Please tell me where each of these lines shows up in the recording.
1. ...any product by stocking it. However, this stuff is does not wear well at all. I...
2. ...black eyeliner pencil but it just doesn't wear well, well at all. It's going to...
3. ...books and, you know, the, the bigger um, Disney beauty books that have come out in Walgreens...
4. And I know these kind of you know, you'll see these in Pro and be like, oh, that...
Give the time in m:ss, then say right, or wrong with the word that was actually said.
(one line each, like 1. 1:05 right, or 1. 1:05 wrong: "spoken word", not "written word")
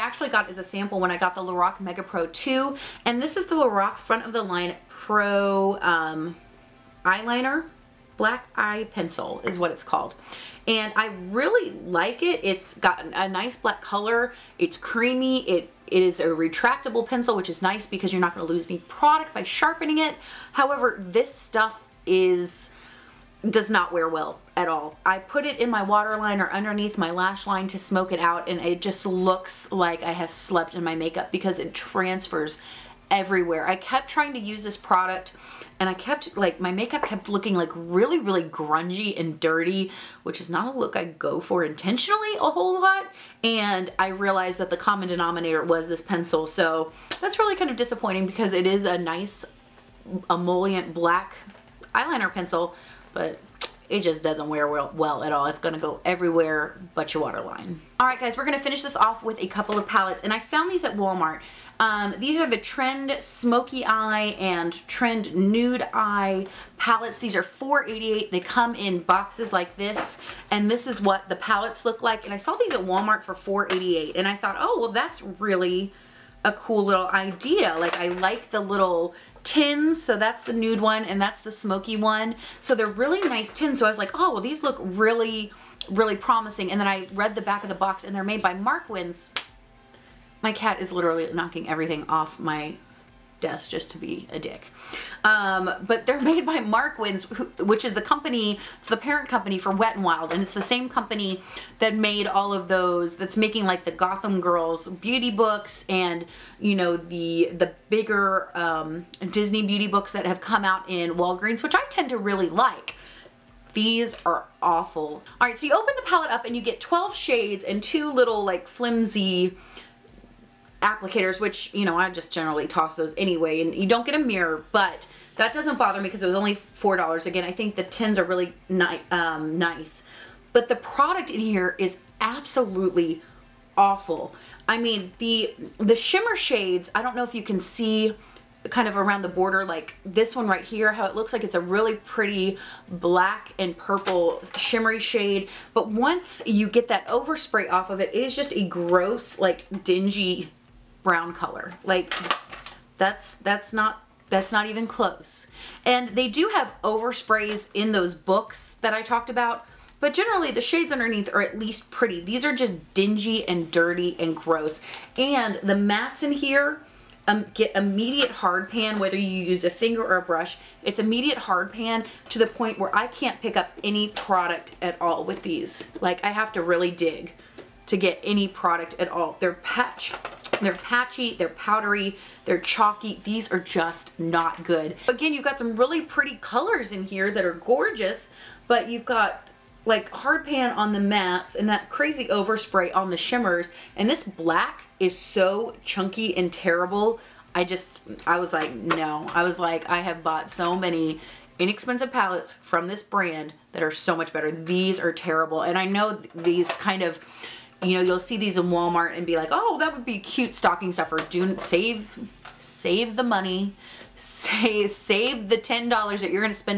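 1. 0:18 wrong: "sharpening", not "stocking"
2. 0:50 right
3. 1:45 right
4. 3:25 wrong: "Walmart", not "Pro".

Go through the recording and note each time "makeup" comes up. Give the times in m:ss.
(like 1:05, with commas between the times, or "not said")
0:30, 0:36.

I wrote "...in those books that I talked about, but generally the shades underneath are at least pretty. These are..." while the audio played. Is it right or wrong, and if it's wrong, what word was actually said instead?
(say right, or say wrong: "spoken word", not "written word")
right.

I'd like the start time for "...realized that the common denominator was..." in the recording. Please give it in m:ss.
0:44.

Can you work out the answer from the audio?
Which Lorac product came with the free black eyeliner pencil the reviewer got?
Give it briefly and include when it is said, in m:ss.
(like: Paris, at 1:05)
Lorac Mega Pro 2, at 0:01.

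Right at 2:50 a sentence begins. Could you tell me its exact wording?
It's immediate hard pan to the point where I can't pick up any product at all with these.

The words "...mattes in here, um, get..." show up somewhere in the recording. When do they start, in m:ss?
2:45.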